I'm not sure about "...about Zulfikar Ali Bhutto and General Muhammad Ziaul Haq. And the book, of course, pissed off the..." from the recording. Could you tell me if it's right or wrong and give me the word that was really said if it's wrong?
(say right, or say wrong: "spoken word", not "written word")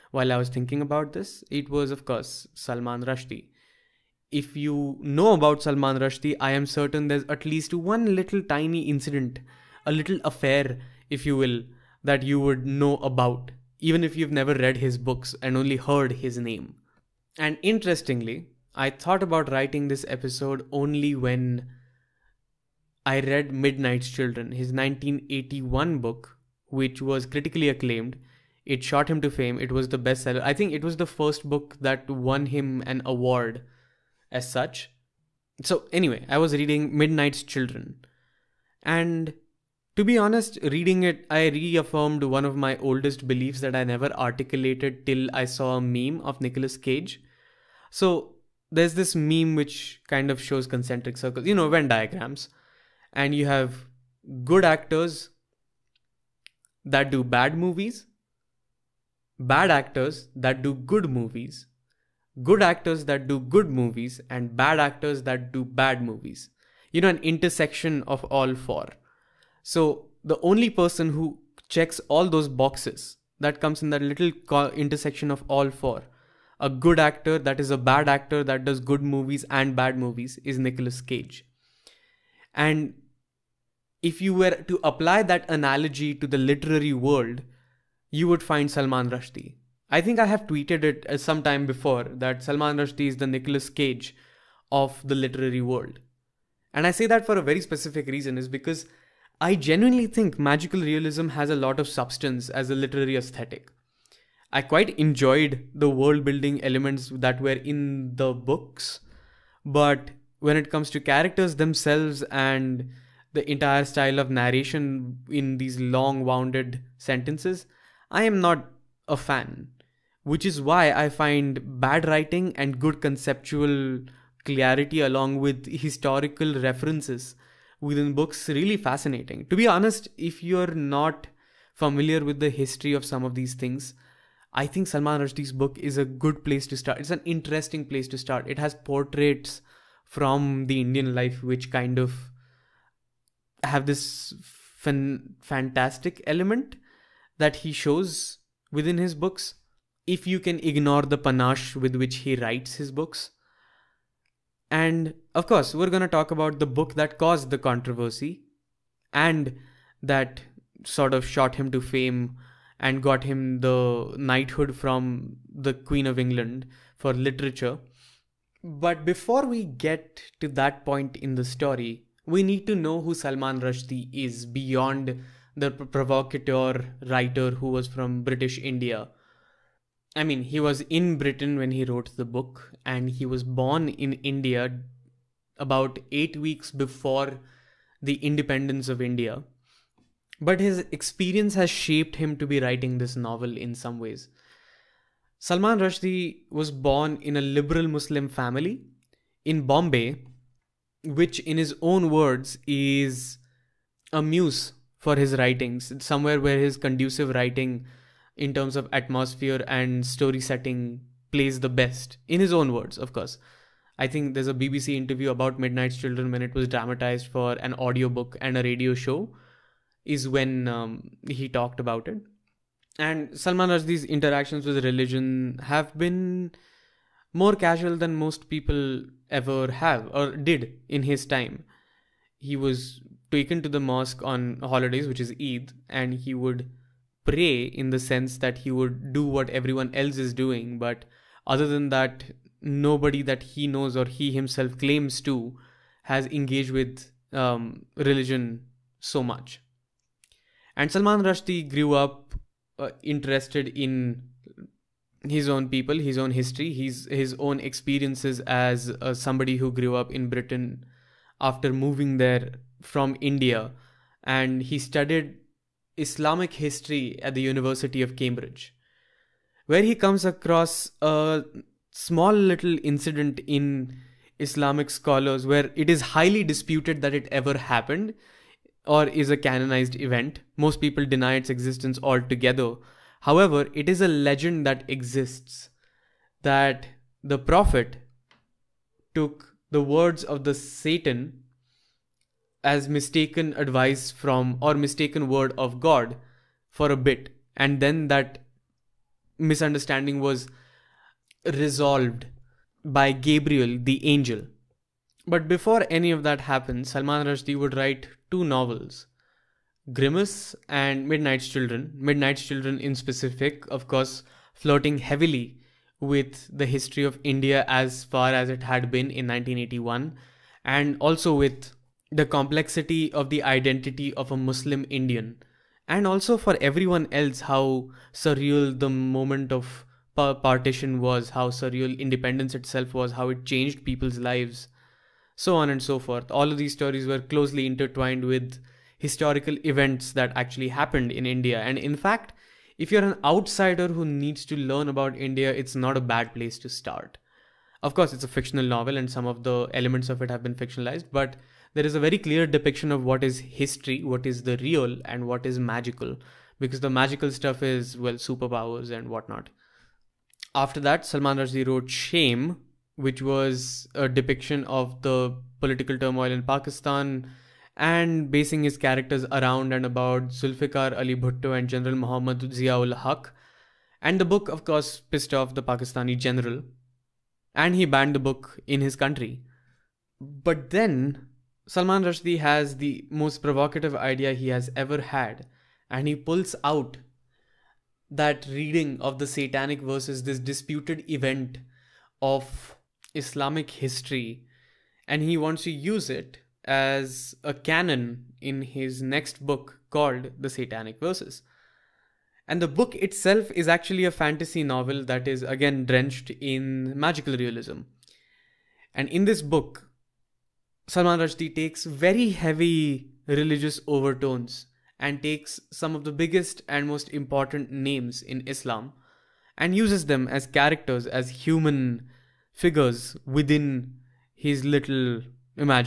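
right.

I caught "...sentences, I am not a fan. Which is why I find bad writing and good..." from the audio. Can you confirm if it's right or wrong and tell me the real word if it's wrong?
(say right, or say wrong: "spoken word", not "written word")
right.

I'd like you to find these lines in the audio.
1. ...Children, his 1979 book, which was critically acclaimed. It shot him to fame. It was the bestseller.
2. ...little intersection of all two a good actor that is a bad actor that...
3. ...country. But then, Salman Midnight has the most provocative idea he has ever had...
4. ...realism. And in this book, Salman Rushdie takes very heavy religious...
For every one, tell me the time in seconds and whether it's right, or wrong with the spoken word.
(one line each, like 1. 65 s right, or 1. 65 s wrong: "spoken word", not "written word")
1. 24 s wrong: "1981", not "1979"
2. 74 s wrong: "four", not "two"
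3. 378 s wrong: "Rushdie", not "Midnight"
4. 407 s right.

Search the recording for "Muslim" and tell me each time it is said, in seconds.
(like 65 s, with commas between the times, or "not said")
197 s, 324 s.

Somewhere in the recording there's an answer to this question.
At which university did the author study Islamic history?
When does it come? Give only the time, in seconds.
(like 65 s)
267 s.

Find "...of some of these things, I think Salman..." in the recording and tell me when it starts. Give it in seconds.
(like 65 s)
132 s.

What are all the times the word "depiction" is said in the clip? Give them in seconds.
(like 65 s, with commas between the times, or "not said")
352 s, 364 s.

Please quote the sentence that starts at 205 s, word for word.
It's somewhere where his conducive writing, in terms of atmosphere and story setting, plays the best, in his own words, of course.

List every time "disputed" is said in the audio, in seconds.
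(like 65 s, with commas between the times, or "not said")
276 s, 390 s.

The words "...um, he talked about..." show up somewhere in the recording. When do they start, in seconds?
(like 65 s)
220 s.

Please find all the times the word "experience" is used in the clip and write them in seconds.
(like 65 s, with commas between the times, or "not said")
190 s, 257 s.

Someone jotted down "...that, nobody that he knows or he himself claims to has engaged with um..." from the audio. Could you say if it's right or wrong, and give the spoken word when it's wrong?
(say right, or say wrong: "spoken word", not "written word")
right.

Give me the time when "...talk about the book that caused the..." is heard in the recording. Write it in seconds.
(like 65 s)
156 s.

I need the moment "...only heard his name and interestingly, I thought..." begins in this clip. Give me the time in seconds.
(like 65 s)
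15 s.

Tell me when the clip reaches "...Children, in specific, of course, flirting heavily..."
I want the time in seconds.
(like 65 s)
312 s.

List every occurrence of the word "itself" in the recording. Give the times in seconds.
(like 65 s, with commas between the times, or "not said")
332 s, 402 s.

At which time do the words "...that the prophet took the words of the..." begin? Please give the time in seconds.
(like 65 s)
286 s.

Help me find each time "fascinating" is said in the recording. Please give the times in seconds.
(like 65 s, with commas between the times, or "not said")
128 s.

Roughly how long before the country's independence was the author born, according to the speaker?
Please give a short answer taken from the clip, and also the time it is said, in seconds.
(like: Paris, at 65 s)
Eight weeks, at 186 s.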